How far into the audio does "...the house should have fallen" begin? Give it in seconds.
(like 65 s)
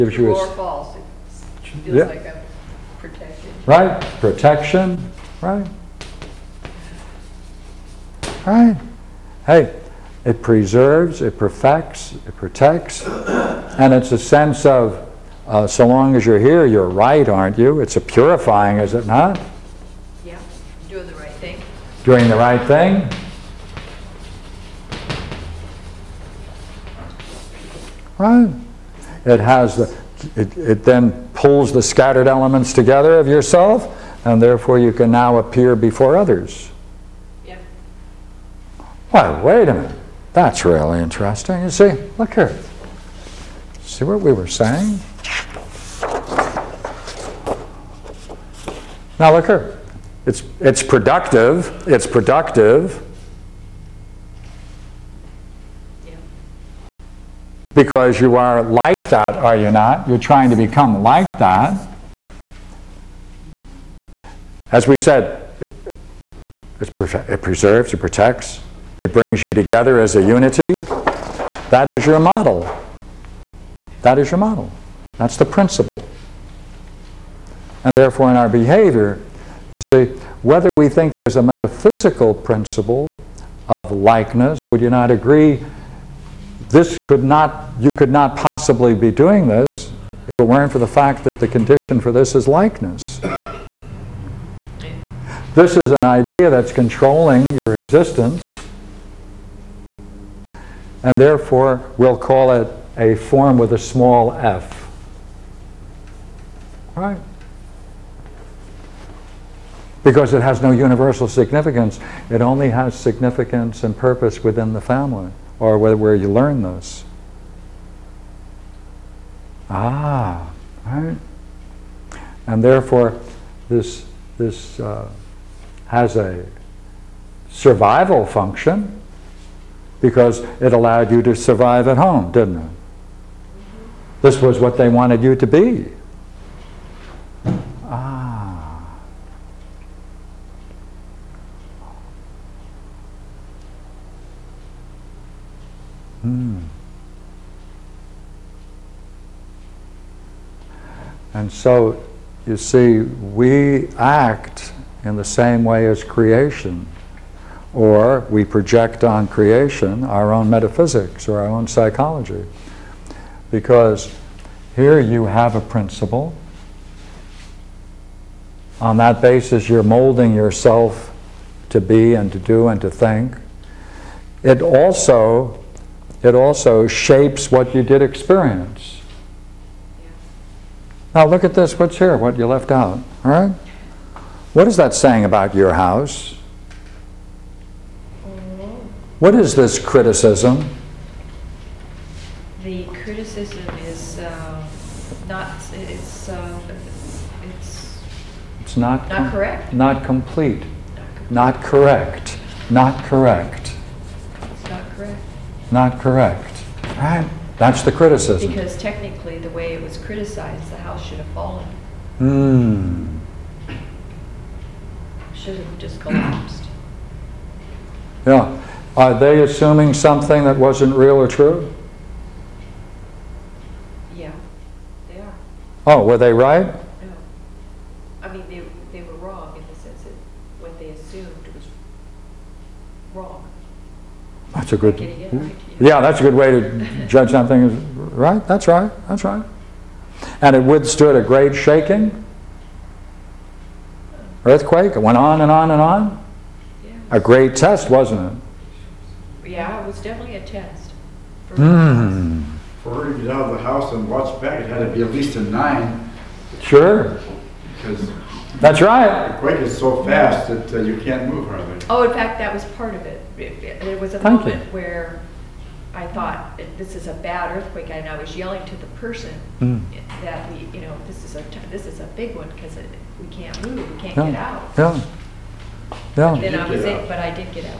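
210 s.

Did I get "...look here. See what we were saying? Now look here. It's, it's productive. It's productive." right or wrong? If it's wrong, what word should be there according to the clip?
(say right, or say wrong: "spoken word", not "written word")
right.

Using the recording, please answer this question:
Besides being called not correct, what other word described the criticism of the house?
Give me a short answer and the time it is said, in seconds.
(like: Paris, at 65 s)
Not complete, at 199 s.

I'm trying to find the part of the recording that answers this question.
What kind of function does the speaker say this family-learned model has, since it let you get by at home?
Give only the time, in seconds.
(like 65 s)
127 s.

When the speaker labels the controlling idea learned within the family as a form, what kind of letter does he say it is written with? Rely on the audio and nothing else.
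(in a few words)
small f.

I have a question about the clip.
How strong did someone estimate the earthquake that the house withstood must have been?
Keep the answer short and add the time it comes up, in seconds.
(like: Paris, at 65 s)
9, at 255 s.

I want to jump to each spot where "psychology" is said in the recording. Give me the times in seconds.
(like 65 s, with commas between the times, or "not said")
161 s.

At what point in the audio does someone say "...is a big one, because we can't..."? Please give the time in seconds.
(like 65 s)
271 s.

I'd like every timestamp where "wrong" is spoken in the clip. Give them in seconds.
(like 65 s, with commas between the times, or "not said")
229 s, 233 s.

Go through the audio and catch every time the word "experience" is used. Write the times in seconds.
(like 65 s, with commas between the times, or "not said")
178 s.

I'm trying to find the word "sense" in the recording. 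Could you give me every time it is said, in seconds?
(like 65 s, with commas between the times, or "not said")
14 s, 229 s.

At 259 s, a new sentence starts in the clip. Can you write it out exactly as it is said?
The quake is so fast that uh, you can't move hardly.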